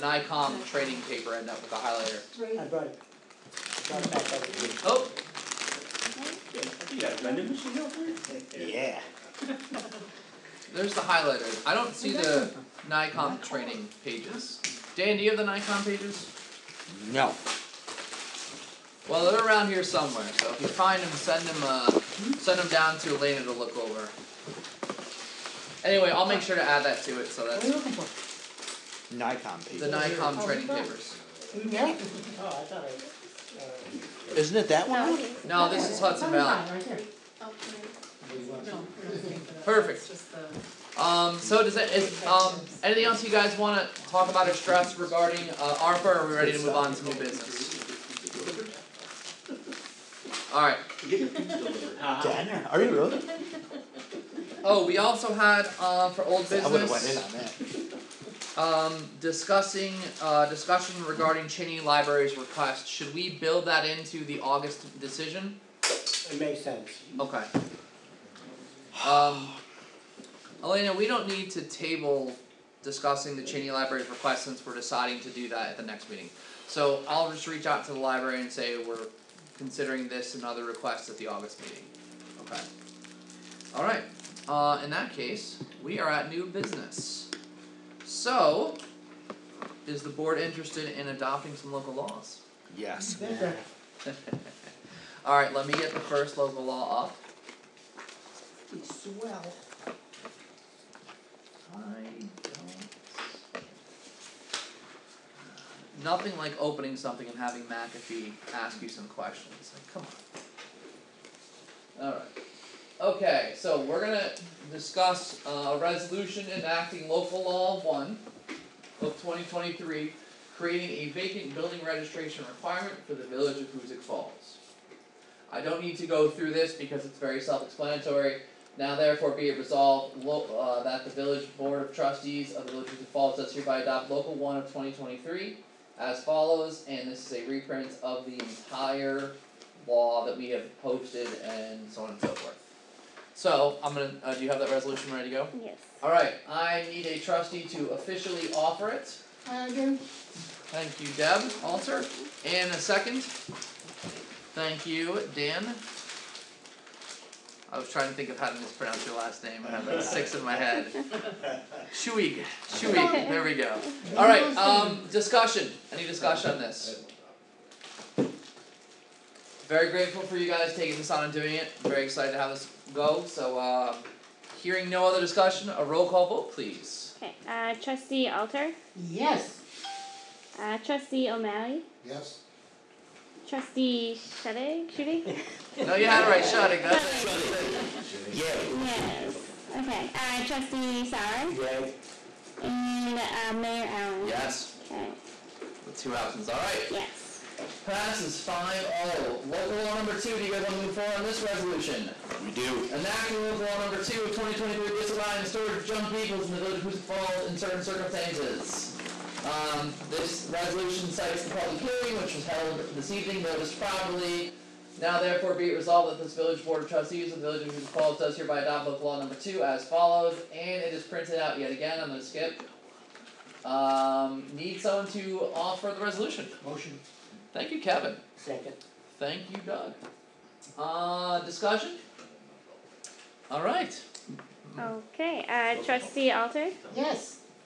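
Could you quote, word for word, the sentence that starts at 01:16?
So I'll just reach out to the library and say we're considering this and other requests at the August meeting.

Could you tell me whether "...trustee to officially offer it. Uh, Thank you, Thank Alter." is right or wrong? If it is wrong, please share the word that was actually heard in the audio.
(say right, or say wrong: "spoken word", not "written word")
wrong: "Deb", not "Thank".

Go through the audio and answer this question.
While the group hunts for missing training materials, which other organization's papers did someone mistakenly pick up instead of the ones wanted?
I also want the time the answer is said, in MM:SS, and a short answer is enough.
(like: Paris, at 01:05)
Hudson Valley, at 00:36.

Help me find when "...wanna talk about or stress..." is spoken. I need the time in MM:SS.
00:43.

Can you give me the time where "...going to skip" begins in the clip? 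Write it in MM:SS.
03:42.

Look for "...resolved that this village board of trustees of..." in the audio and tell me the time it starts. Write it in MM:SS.
03:35.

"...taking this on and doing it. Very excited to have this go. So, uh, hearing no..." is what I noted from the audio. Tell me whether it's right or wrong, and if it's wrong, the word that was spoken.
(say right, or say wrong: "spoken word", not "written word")
right.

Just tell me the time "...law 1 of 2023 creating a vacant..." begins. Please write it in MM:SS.
01:57.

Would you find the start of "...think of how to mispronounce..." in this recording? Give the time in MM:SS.
02:38.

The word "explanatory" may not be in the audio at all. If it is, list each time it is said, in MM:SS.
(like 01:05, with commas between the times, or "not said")
02:07.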